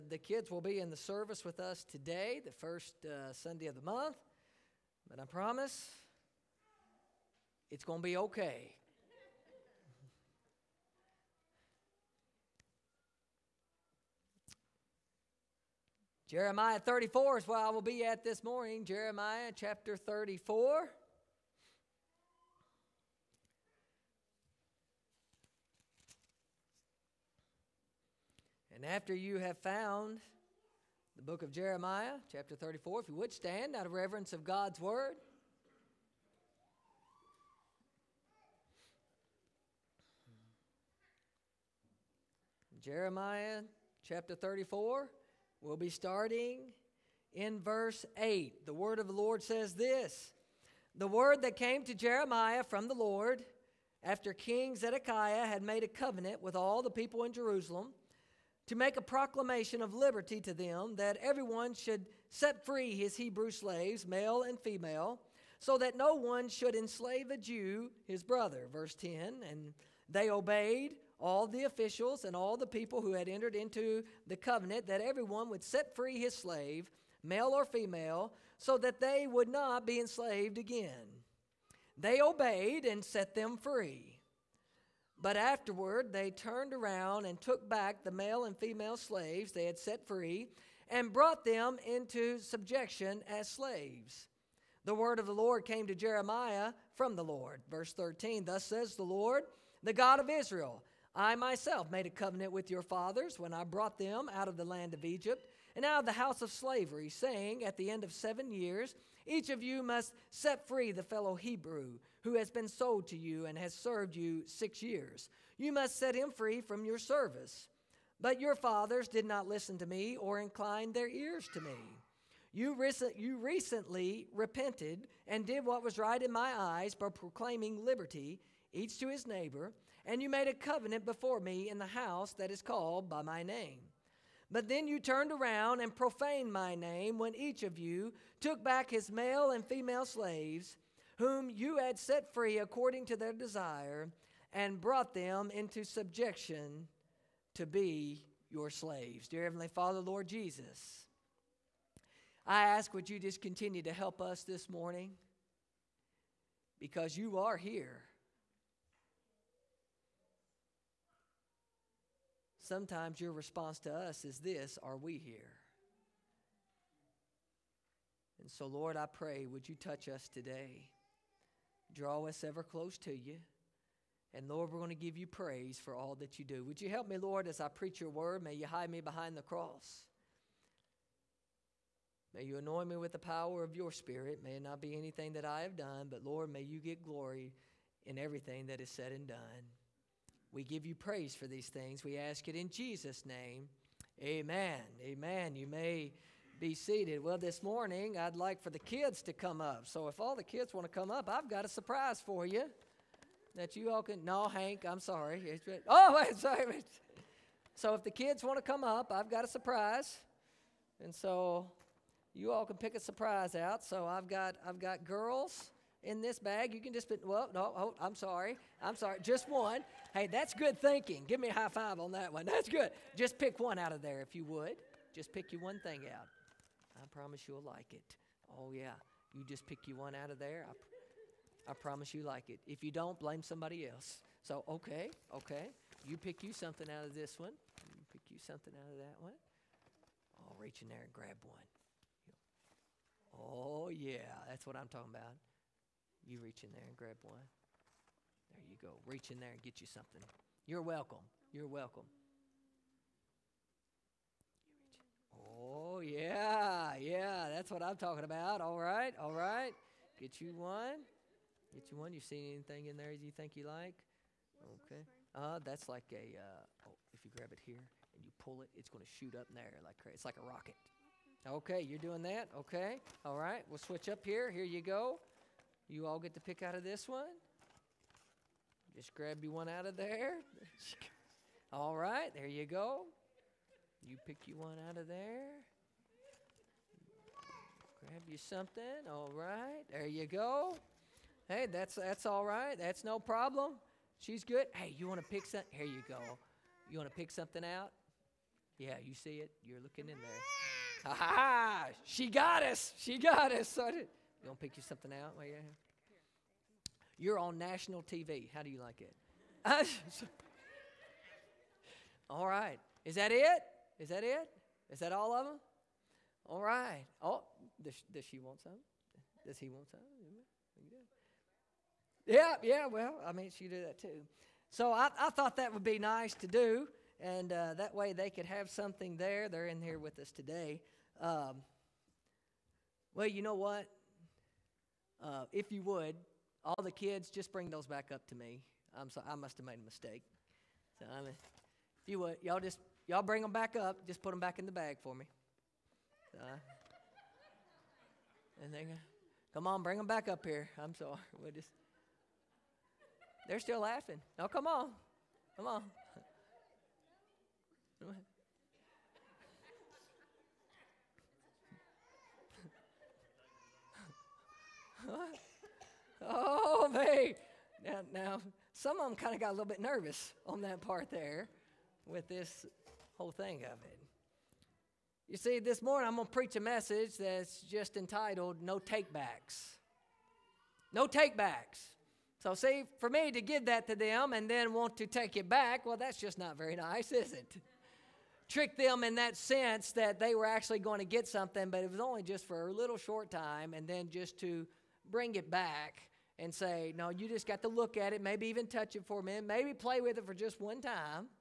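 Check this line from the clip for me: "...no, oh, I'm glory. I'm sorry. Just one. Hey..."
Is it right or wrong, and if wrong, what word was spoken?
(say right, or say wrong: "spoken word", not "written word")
wrong: "sorry", not "glory".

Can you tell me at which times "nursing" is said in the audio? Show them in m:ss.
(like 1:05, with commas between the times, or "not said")
not said.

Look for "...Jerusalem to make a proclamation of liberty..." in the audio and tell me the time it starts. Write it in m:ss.
0:57.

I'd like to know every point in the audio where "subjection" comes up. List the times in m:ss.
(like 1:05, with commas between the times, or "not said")
1:32, 2:25.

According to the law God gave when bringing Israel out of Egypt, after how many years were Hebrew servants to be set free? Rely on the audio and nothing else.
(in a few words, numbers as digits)
7.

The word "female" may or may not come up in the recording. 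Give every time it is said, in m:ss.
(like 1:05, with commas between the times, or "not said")
1:04, 1:17, 1:28, 2:19.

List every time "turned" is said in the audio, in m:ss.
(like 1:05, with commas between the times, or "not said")
1:26, 2:14.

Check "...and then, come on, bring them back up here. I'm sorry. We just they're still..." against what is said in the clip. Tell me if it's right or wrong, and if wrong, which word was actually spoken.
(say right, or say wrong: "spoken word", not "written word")
right.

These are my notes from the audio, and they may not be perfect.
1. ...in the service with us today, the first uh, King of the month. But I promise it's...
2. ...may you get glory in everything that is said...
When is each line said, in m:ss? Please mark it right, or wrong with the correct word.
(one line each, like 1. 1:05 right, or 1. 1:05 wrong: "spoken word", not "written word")
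1. 0:00 wrong: "Sunday", not "King"
2. 3:06 right.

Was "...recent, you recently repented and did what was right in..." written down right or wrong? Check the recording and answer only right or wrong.
right.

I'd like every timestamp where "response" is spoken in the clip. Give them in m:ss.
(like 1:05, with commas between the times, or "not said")
2:43.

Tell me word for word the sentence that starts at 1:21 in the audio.
They obeyed and set them free.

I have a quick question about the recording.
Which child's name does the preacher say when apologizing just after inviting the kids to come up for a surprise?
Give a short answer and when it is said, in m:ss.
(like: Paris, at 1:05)
Hank, at 3:24.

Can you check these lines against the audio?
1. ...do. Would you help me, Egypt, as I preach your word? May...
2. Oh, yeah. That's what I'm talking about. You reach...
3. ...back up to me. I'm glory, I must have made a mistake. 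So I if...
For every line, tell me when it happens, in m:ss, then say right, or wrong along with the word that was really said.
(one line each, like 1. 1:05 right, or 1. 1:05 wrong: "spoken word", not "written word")
1. 2:56 wrong: "Lord", not "Egypt"
2. 4:03 right
3. 5:37 wrong: "sorry", not "glory".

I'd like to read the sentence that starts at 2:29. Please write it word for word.
Dear Heavenly Father, Lord Jesus, I ask would you just continue to help us this morning?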